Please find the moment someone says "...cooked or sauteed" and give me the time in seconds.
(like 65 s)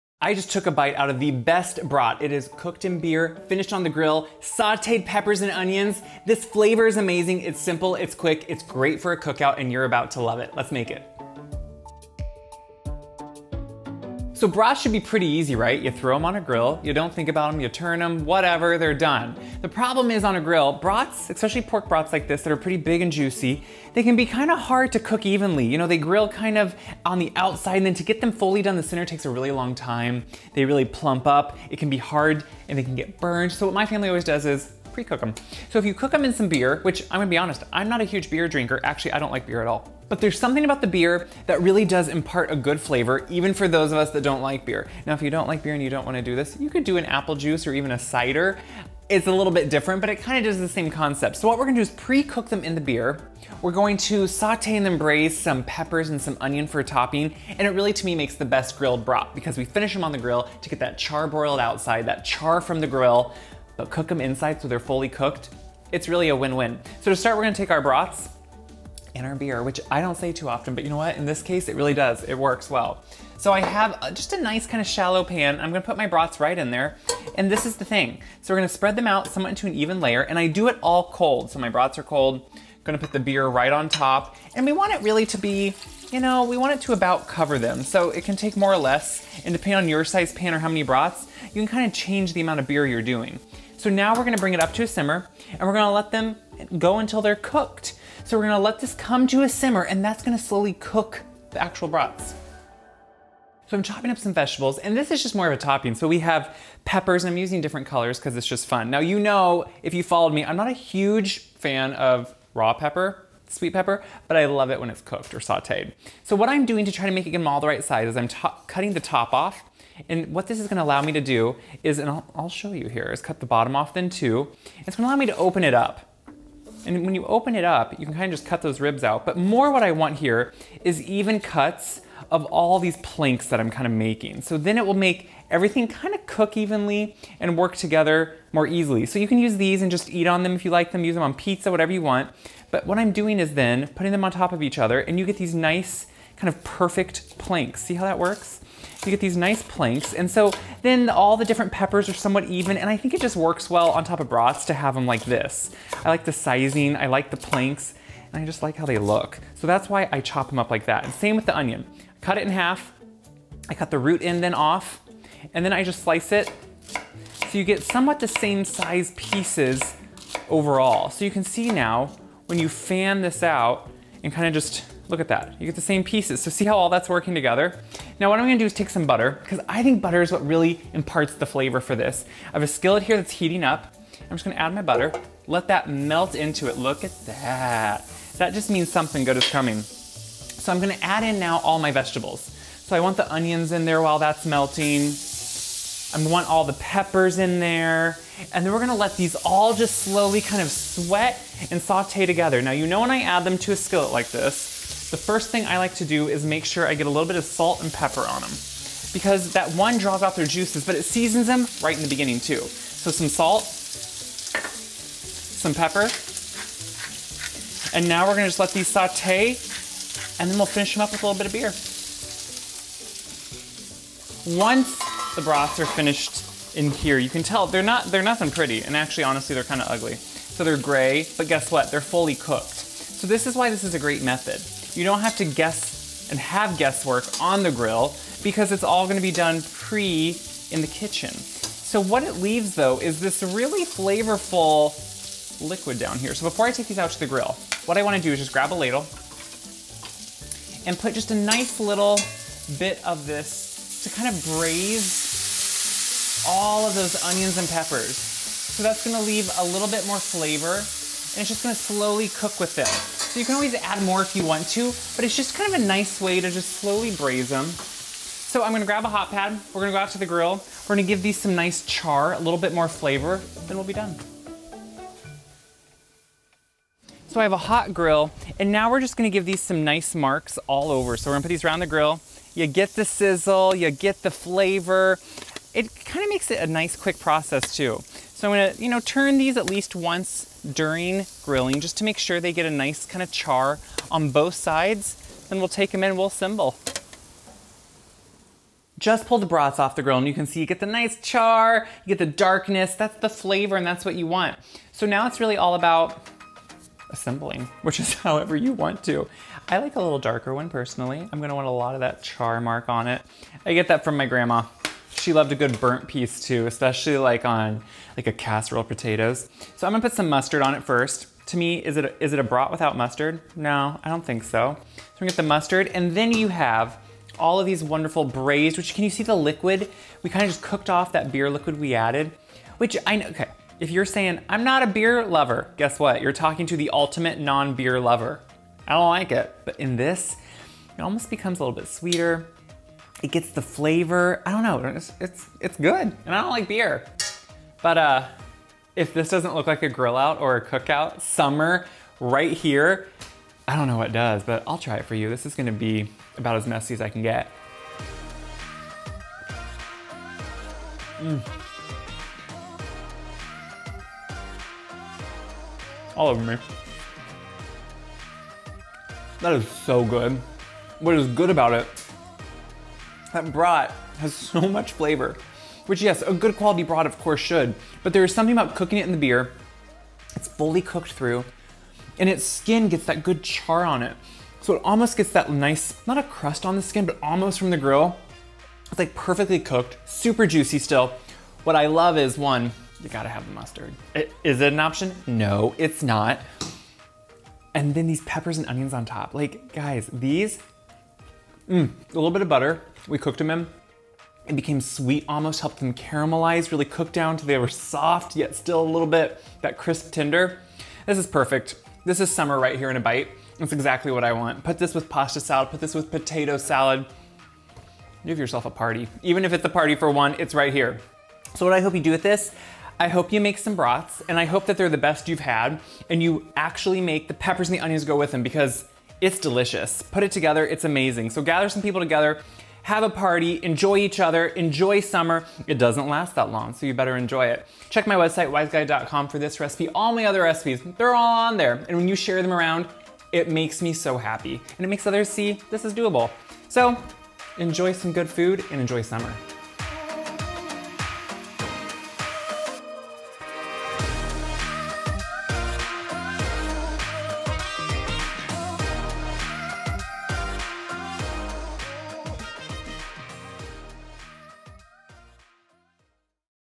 115 s.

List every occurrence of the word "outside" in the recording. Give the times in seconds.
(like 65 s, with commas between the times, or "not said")
27 s, 61 s.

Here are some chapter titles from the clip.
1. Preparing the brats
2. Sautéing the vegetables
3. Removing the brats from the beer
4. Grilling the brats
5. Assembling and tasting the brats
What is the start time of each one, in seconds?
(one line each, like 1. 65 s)
1. 66 s
2. 103 s
3. 223 s
4. 276 s
5. 298 s.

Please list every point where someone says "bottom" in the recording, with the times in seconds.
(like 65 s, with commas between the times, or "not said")
123 s.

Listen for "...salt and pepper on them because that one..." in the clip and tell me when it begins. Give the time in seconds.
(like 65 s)
207 s.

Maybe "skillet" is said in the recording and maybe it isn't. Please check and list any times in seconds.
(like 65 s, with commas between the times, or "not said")
182 s, 203 s.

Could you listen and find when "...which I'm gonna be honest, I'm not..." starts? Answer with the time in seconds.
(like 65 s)
36 s.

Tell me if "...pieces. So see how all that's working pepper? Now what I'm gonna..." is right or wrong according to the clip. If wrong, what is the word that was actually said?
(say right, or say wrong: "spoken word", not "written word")
wrong: "together", not "pepper".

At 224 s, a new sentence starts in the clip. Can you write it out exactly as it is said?
Once the brats are finished in here, you can tell they're not they're nothing pretty, and actually honestly they're kind of ugly.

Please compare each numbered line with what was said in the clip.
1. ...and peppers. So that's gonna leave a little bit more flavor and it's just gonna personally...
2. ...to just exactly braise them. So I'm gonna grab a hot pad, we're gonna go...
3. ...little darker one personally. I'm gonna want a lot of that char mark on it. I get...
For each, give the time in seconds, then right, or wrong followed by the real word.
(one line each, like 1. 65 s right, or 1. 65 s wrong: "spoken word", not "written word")
1. 257 s wrong: "slowly", not "personally"
2. 266 s wrong: "slowly", not "exactly"
3. 310 s right.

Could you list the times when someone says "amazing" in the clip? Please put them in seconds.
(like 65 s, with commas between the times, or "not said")
6 s, 430 s.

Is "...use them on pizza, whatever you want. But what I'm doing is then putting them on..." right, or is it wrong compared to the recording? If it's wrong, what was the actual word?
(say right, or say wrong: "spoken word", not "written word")
right.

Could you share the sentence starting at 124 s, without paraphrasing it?
It's gonna allow me to open it up.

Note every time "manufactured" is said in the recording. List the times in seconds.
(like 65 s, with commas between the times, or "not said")
not said.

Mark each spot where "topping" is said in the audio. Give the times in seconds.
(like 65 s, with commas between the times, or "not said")
56 s, 105 s.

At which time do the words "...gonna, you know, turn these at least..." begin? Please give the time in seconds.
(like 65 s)
288 s.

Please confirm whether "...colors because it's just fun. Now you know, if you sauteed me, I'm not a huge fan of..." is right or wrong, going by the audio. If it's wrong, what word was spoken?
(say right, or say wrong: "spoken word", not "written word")
wrong: "followed", not "sauteed".